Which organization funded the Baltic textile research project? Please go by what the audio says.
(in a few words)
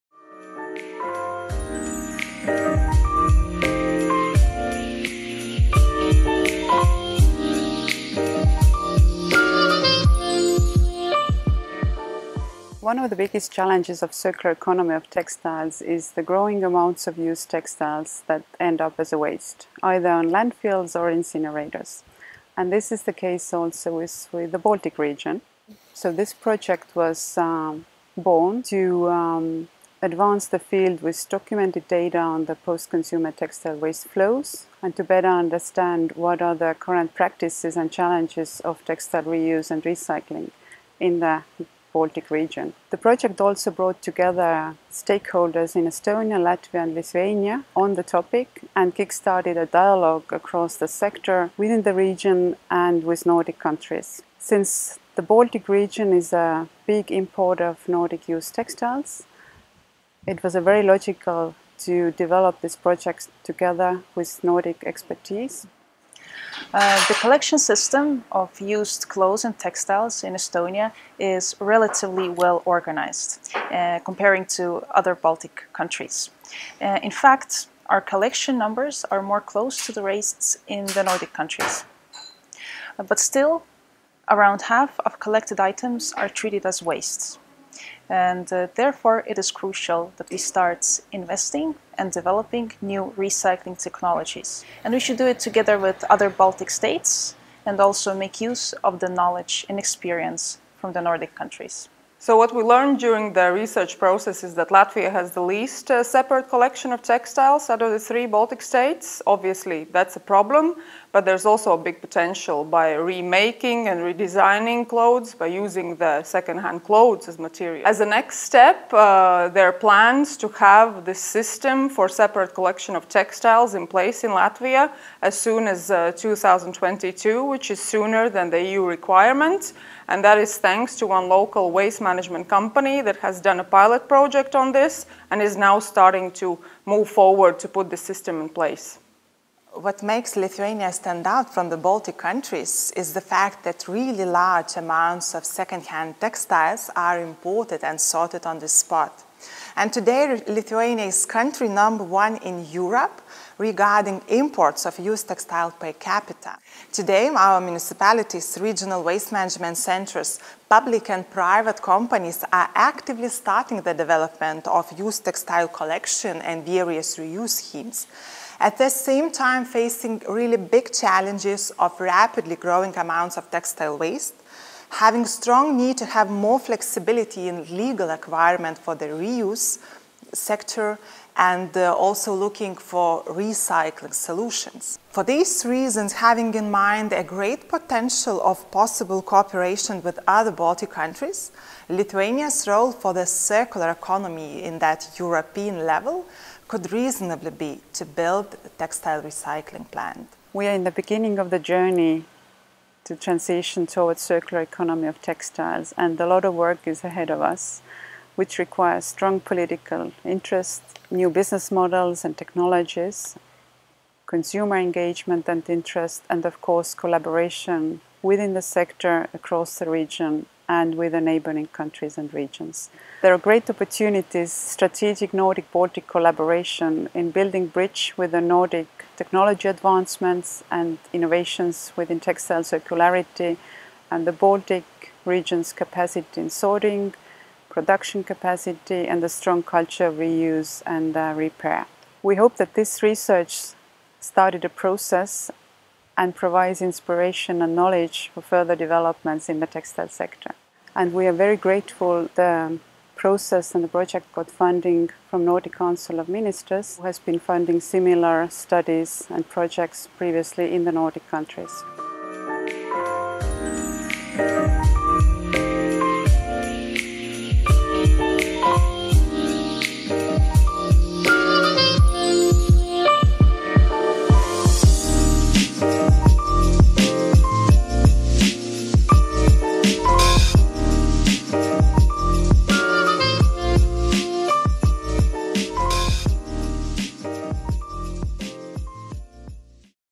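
Nordic Council of Ministers.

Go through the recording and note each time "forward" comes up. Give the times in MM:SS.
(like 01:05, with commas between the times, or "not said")
02:17.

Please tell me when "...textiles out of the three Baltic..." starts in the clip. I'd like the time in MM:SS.
01:47.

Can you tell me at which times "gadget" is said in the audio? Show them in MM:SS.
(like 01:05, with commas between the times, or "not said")
not said.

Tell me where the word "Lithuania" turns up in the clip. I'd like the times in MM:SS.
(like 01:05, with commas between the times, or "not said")
00:46, 02:20, 02:30, 03:11.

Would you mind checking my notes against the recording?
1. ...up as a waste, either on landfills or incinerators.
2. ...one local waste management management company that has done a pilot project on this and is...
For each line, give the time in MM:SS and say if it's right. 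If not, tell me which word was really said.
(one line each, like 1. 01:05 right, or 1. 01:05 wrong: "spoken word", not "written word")
1. 00:18 right
2. 02:11 right.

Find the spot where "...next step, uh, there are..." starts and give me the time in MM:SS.
01:58.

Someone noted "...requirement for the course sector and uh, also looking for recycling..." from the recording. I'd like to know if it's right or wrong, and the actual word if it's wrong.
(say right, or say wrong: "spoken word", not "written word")
wrong: "reuse", not "course".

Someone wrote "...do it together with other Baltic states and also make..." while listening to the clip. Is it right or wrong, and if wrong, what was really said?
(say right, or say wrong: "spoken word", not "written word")
right.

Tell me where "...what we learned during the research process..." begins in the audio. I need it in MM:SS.
01:42.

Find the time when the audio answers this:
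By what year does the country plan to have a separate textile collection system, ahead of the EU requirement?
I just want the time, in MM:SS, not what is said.
02:06.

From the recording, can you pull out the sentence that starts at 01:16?
Uh, in fact, our collection numbers are more close to the rates in the Nordic countries.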